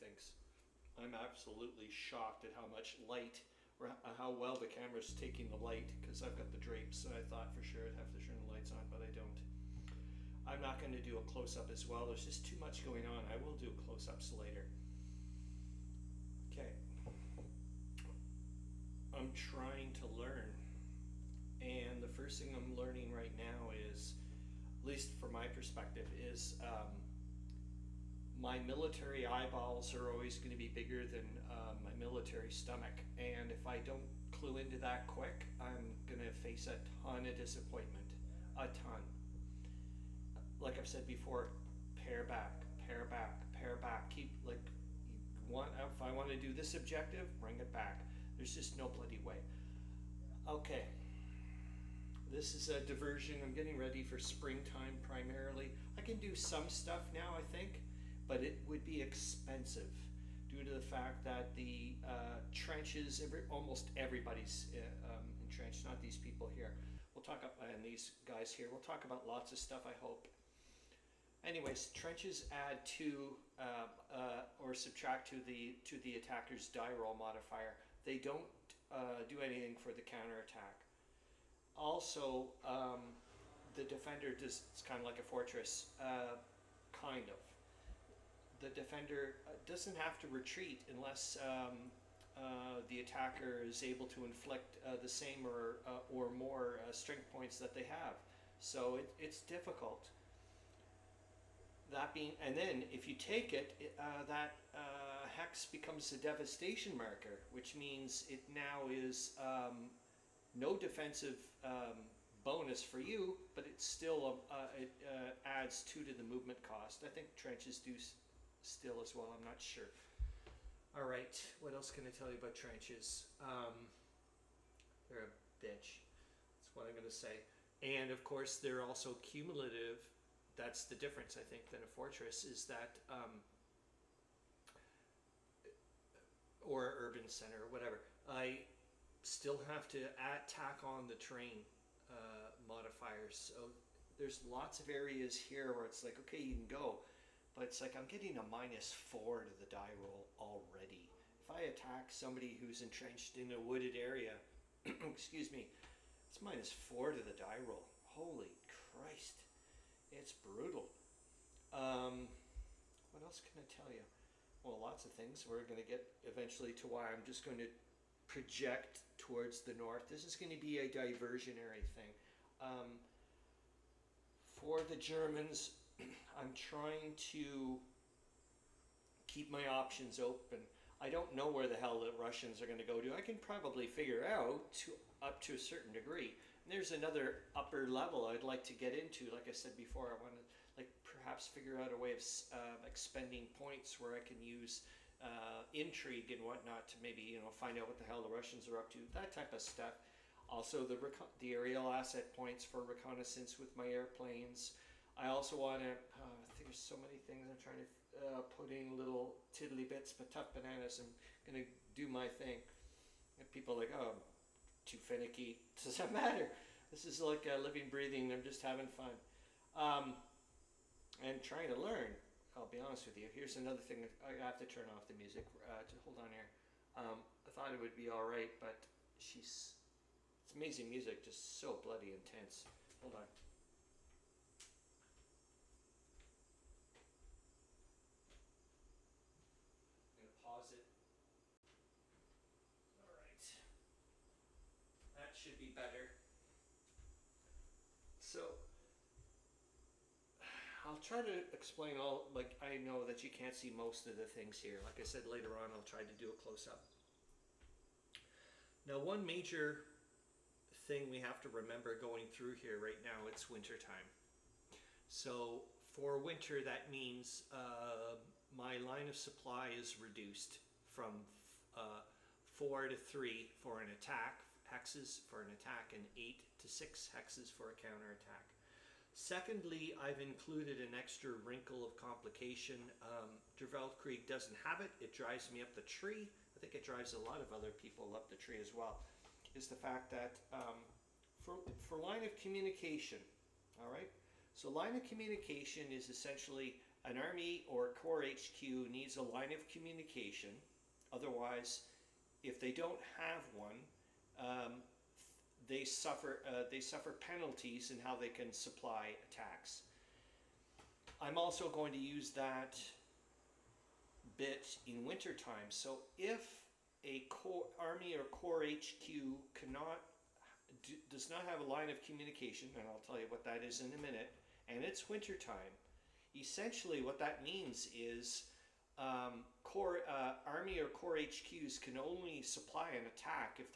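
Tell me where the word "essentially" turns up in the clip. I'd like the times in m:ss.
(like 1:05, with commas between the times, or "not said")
4:56, 5:26.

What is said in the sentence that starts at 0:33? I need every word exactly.
And if I don't clue into that quick, I'm going to face a ton of disappointment.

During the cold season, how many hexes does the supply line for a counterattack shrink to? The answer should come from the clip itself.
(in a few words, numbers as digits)
6.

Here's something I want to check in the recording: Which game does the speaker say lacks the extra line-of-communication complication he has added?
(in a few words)
Der Weltkrieg.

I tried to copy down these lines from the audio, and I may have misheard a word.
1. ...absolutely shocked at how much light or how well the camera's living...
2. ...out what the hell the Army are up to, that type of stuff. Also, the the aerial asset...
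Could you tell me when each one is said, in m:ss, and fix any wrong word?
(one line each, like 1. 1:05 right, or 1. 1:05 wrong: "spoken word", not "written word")
1. 0:01 wrong: "taking", not "living"
2. 3:17 wrong: "Russians", not "Army".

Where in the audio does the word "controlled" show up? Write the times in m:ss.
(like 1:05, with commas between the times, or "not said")
not said.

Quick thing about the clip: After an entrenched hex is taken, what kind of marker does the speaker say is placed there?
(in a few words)
devastation marker.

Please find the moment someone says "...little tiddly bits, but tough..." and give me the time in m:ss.
3:28.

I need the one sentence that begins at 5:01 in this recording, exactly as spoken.
Otherwise, if they don't have one, um, they suffer, uh, they suffer penalties in how they can supply attacks.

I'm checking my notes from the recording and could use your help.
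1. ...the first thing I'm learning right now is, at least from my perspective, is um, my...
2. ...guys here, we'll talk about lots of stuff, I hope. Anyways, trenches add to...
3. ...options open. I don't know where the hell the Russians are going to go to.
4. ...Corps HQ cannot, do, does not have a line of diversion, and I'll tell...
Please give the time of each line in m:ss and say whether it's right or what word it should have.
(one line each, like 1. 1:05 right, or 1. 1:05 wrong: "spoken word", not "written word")
1. 0:22 right
2. 1:08 right
3. 2:59 right
4. 5:18 wrong: "communication", not "diversion".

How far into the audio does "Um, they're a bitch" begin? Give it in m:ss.
2:03.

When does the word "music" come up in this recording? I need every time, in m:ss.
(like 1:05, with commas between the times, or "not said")
3:45, 3:50.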